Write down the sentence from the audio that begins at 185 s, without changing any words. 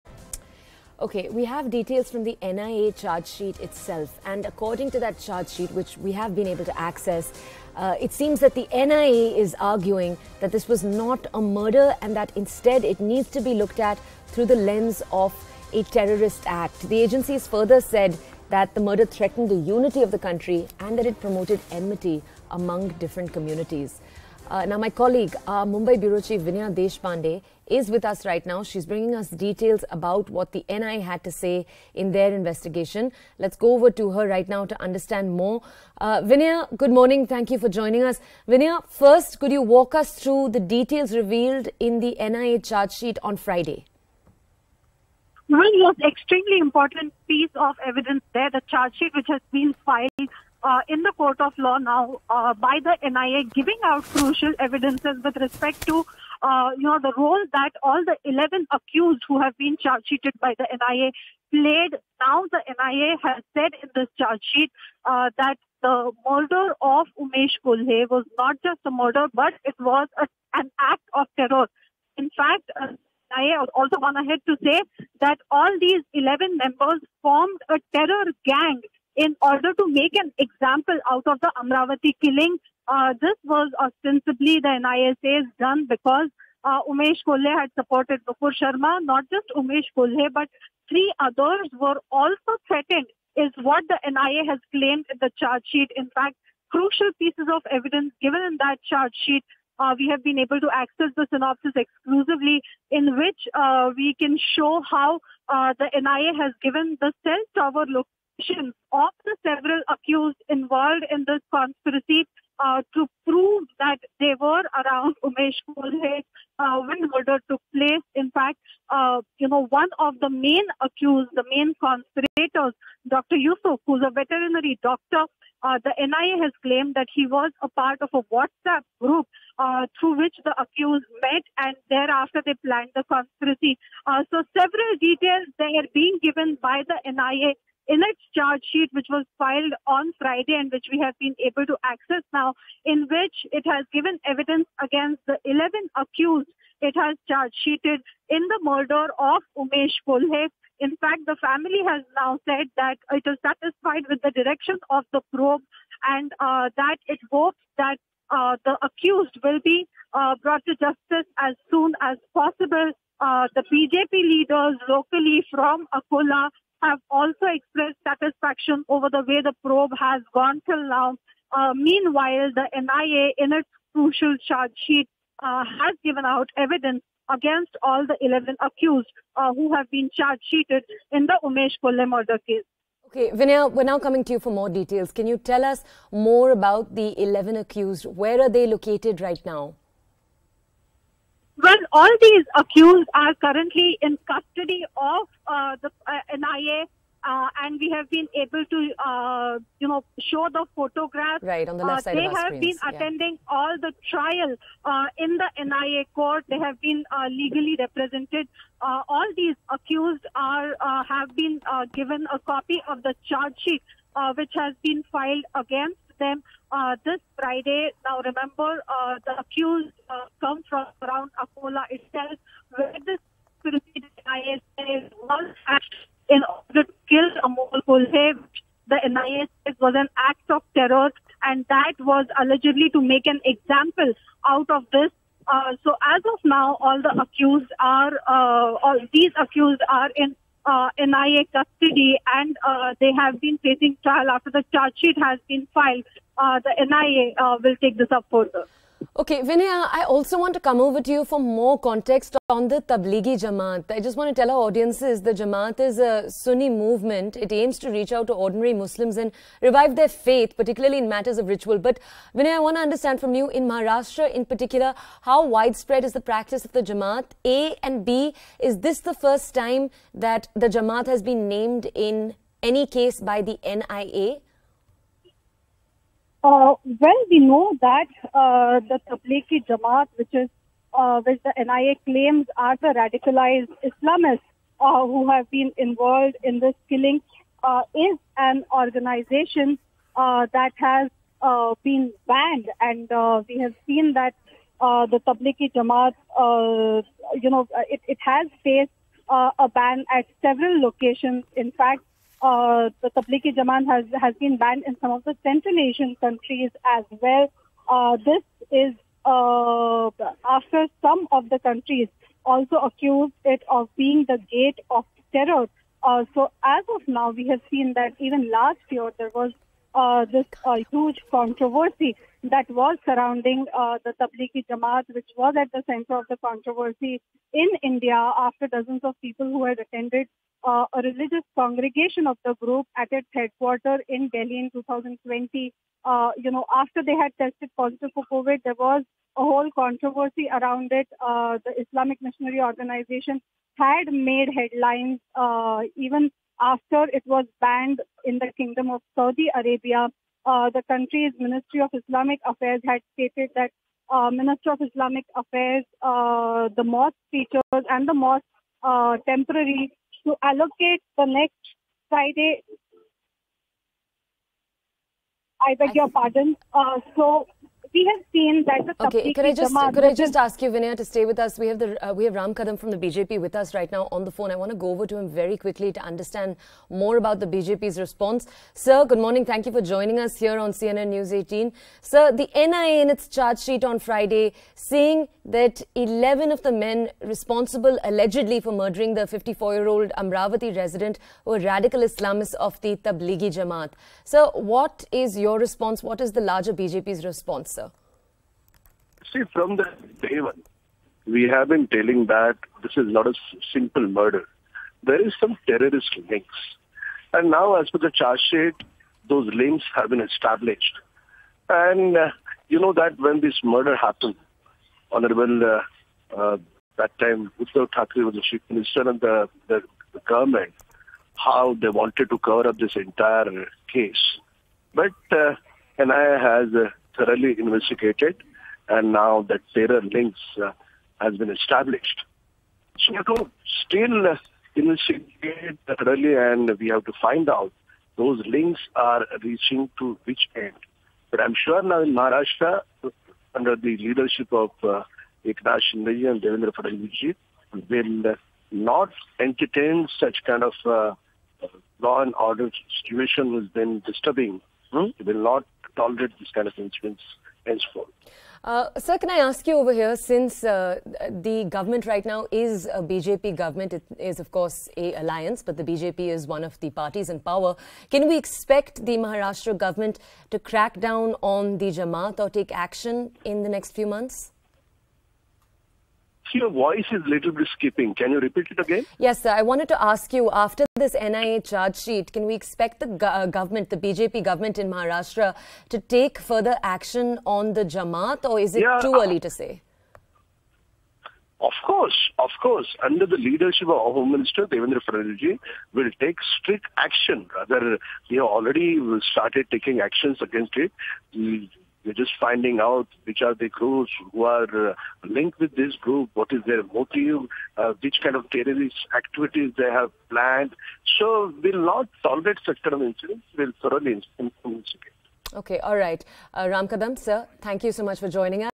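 Can you tell us more about the 11 accused?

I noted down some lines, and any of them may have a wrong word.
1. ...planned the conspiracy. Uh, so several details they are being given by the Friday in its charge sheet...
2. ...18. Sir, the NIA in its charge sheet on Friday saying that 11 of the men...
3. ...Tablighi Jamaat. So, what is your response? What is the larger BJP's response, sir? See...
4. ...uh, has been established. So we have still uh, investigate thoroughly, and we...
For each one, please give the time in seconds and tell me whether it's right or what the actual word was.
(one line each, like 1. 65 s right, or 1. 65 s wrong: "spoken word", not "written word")
1. 132 s wrong: "NIA", not "Friday"
2. 381 s right
3. 392 s right
4. 430 s right.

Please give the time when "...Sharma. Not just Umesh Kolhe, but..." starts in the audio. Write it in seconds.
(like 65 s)
88 s.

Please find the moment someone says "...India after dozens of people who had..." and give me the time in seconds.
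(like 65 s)
327 s.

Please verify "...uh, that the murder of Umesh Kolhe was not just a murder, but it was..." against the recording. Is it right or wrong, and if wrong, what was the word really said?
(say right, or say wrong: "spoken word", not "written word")
right.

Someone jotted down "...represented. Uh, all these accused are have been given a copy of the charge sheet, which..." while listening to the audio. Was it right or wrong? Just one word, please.
right.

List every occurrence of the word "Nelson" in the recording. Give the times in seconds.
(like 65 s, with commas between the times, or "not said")
not said.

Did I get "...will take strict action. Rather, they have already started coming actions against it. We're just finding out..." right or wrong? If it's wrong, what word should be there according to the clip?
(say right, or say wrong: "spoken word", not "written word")
wrong: "taking", not "coming".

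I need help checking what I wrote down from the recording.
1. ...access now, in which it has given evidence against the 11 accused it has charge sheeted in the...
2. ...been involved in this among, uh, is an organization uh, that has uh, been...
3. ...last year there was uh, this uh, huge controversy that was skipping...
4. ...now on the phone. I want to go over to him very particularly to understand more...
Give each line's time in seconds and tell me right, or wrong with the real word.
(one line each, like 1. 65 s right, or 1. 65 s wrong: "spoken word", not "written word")
1. 141 s right
2. 285 s wrong: "killing", not "among"
3. 318 s wrong: "surrounding", not "skipping"
4. 373 s wrong: "quickly", not "particularly".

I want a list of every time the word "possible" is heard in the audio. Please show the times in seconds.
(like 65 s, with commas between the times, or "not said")
162 s.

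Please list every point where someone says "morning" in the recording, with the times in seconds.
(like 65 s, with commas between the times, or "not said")
36 s, 379 s.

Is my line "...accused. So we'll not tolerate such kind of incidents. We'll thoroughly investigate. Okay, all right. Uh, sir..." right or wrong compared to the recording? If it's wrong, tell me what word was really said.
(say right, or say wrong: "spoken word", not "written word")
wrong: "planned", not "accused".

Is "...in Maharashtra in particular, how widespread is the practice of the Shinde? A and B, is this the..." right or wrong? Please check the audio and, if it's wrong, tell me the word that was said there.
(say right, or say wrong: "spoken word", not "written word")
wrong: "Jamaat", not "Shinde".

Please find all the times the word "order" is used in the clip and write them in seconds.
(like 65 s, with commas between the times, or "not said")
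79 s, 226 s, 452 s.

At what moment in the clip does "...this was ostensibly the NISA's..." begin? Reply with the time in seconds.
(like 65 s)
83 s.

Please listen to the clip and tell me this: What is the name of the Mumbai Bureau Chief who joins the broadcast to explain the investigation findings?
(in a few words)
Vinaya Deshpande.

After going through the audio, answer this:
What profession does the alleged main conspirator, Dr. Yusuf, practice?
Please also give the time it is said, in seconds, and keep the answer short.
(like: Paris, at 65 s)
Veterinary doctor, at 124 s.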